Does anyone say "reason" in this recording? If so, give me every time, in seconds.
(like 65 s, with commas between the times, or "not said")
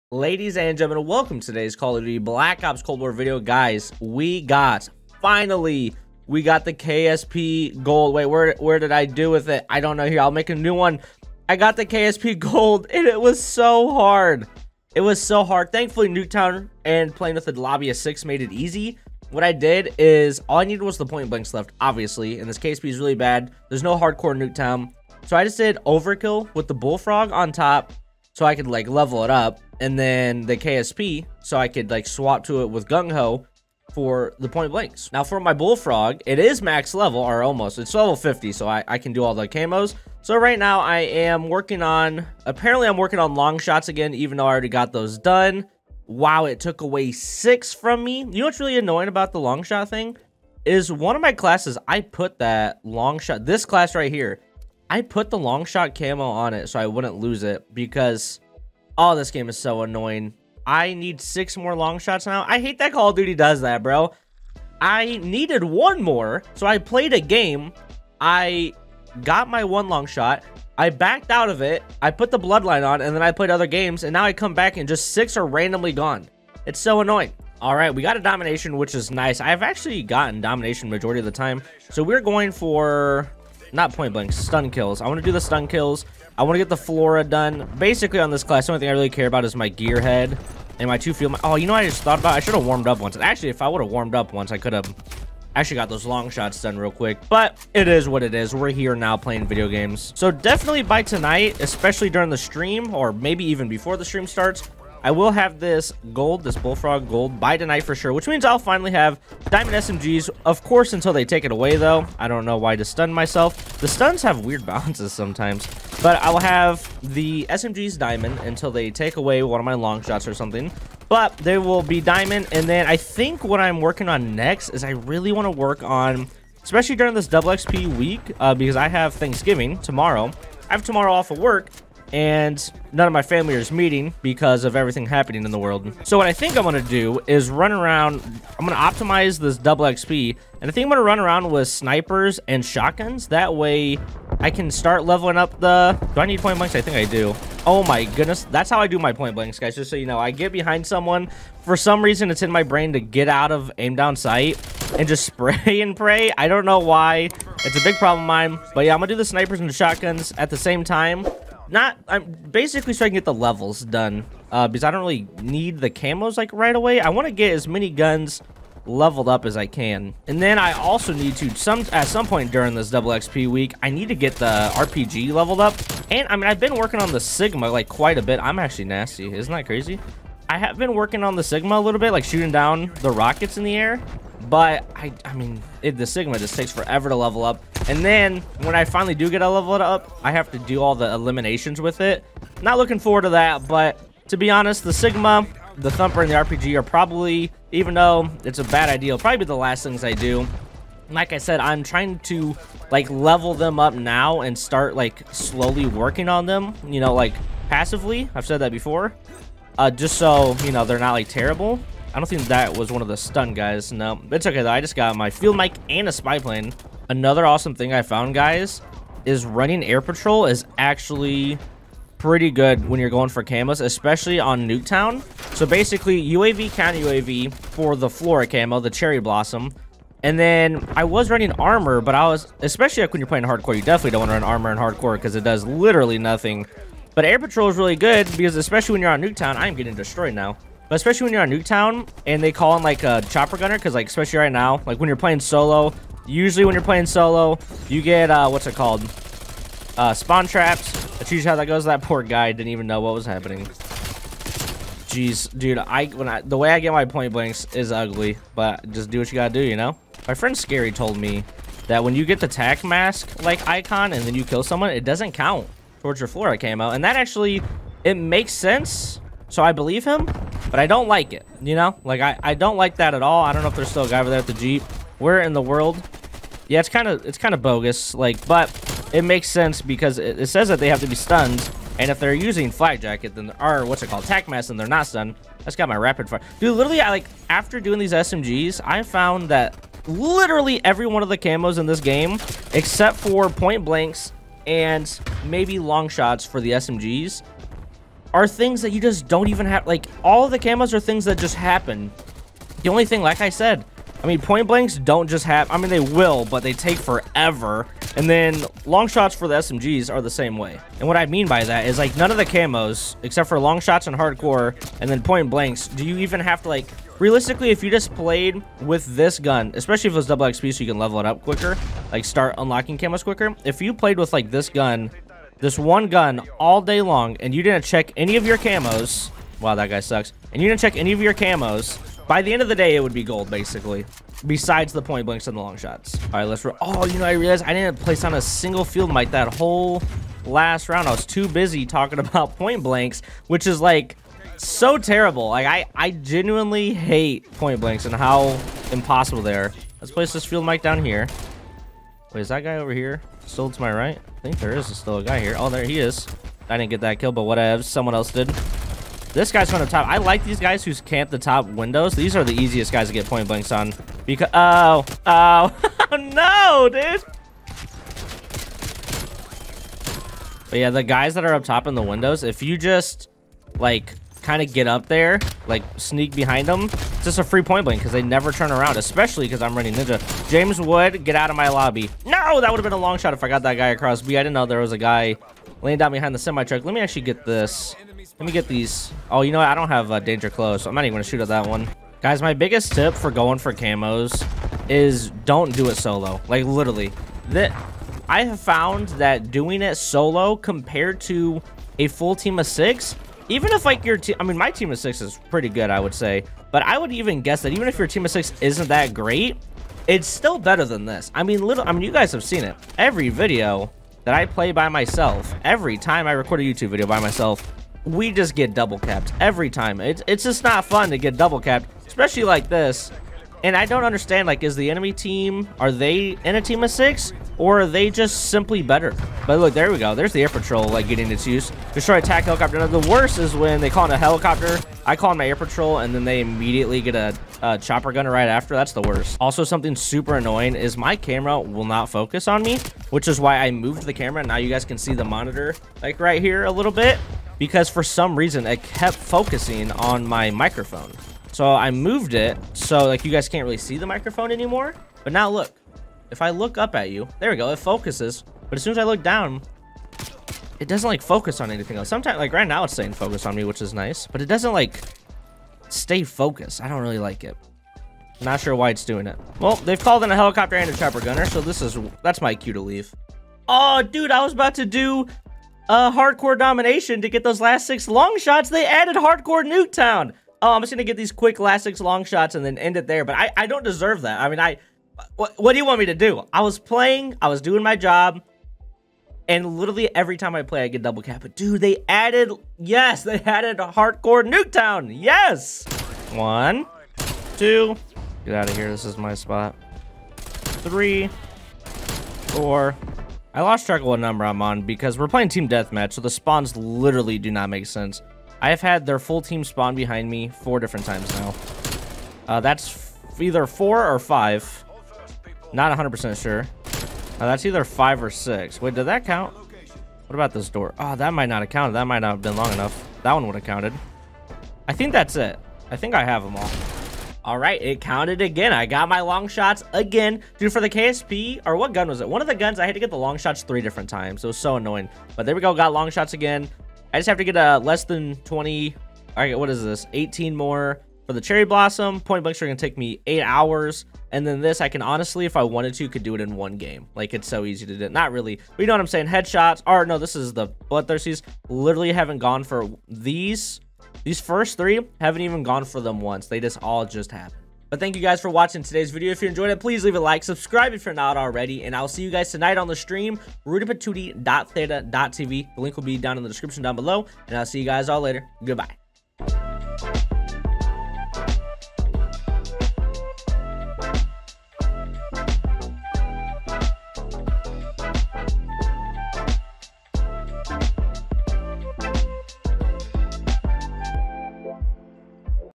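152 s, 448 s.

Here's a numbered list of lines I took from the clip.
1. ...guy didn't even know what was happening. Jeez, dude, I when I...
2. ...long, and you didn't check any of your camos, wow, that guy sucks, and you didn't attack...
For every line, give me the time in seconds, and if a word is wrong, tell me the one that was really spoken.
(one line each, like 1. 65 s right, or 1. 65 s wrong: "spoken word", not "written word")
1. 252 s right
2. 326 s wrong: "check", not "attack".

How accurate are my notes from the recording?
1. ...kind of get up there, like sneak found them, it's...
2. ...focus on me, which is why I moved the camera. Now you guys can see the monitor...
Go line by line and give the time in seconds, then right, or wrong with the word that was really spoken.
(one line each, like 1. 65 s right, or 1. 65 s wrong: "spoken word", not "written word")
1. 374 s wrong: "behind", not "found"
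2. 442 s right.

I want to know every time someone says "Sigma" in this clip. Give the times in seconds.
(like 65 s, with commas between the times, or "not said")
177 s, 181 s, 186 s, 194 s.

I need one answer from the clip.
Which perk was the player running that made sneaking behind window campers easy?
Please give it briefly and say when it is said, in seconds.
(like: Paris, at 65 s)
Ninja, at 379 s.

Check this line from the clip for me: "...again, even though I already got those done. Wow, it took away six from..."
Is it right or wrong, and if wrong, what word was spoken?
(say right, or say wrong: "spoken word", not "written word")
right.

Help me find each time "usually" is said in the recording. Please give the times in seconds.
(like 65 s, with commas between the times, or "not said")
246 s, 251 s.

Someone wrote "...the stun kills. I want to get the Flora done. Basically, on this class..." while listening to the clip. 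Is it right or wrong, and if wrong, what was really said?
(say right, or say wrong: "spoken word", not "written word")
right.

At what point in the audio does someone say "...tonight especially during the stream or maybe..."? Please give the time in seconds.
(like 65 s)
101 s.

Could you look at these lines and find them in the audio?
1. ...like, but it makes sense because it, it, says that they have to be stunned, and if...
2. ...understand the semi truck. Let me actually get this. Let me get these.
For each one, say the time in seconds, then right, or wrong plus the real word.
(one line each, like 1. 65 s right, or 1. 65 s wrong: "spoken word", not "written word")
1. 278 s right
2. 386 s wrong: "behind", not "understand".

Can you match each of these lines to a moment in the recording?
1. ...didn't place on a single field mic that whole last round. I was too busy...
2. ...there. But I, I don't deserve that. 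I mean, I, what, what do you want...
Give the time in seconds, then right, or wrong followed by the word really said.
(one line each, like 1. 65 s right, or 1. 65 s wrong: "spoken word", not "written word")
1. 337 s right
2. 483 s right.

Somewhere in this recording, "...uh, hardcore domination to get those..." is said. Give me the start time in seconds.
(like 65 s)
475 s.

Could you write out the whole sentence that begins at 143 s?
That way I can start leveling up the...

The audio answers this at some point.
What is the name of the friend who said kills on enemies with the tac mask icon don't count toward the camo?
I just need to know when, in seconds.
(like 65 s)
260 s.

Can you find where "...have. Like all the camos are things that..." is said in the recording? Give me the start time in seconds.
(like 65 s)
299 s.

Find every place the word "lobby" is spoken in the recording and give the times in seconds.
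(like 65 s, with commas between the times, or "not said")
17 s, 381 s.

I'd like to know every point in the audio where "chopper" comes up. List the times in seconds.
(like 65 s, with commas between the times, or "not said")
243 s, 437 s, 470 s.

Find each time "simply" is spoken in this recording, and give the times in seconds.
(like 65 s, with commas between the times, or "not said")
428 s.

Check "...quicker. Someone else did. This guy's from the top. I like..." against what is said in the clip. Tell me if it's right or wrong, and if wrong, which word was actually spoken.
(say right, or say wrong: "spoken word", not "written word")
wrong: "whatever", not "quicker".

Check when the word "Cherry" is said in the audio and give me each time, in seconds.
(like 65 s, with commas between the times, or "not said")
228 s, 541 s.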